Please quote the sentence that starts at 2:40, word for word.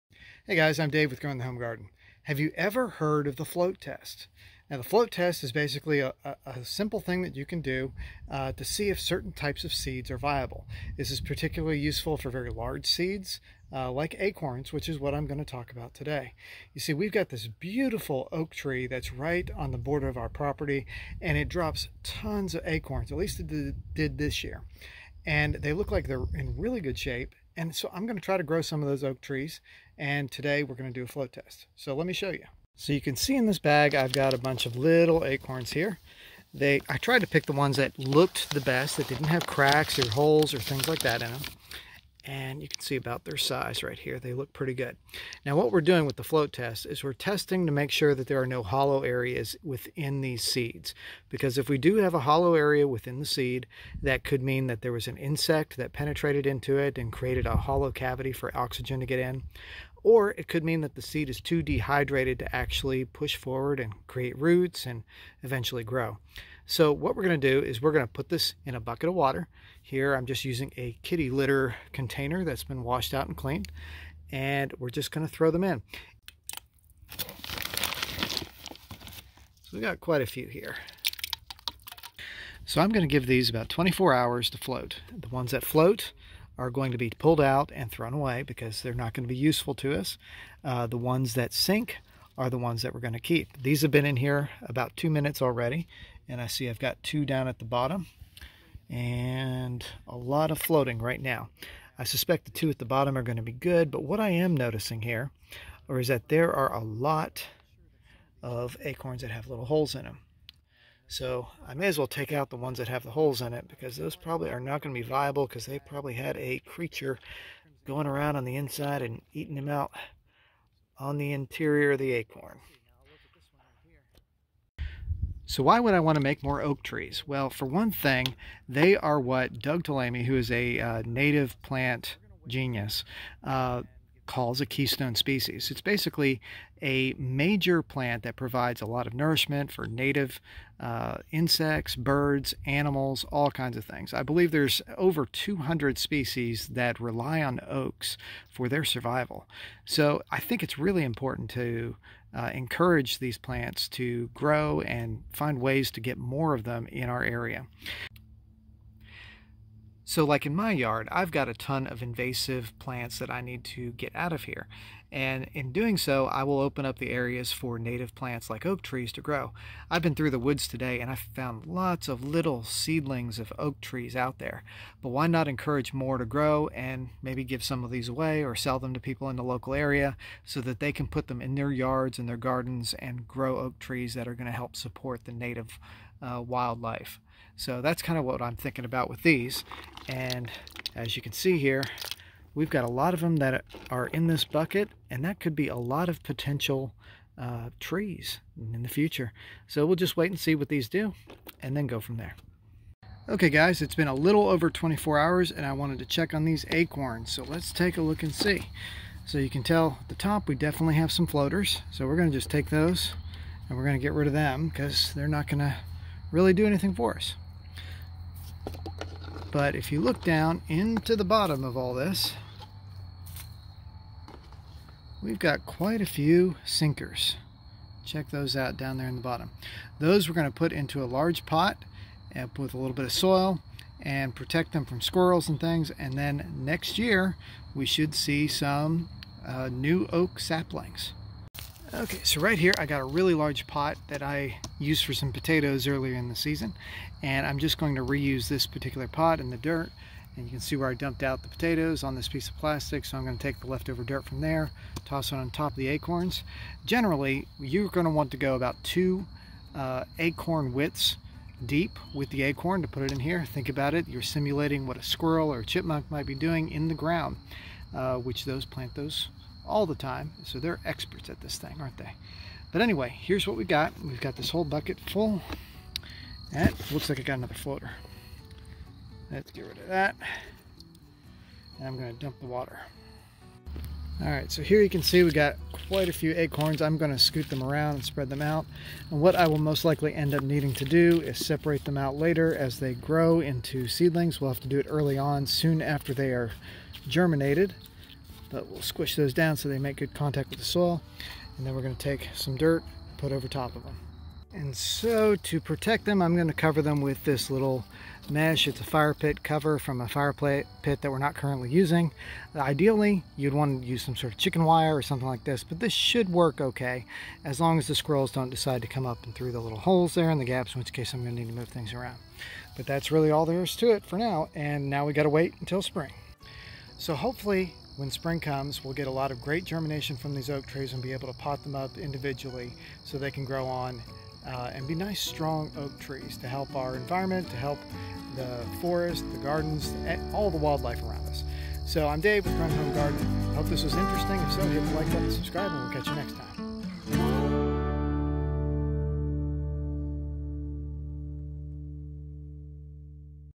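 So, like in my yard, I've got a ton of invasive plants that I need to get out of here.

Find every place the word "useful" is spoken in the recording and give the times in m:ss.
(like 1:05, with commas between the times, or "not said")
0:11, 1:29.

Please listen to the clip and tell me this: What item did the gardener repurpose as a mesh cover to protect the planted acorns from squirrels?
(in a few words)
A fire pit cover.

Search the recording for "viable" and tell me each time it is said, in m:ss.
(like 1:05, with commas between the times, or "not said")
0:10, 1:55.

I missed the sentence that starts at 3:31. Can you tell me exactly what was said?
So we're gonna just take those and we're gonna get rid of them because they're not gonna really do anything for us.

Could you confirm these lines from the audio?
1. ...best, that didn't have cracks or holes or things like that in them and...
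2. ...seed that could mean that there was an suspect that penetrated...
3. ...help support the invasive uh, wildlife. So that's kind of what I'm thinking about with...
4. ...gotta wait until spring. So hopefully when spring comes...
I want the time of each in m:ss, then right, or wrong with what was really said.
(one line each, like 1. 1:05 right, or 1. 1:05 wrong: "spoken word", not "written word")
1. 0:38 right
2. 0:53 wrong: "insect", not "suspect"
3. 3:04 wrong: "native", not "invasive"
4. 5:25 right.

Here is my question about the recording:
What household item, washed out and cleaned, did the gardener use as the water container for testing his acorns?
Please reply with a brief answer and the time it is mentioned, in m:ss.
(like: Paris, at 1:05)
Kitty litter container, at 1:11.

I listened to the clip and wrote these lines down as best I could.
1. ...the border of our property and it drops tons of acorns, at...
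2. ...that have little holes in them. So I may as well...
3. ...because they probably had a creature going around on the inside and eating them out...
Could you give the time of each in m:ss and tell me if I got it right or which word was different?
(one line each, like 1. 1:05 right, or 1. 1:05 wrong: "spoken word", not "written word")
1. 0:19 right
2. 1:49 right
3. 1:55 right.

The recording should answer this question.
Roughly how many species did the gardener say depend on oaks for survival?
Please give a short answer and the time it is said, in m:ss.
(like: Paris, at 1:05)
Over 200, at 2:24.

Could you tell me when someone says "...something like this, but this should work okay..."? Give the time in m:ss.
5:15.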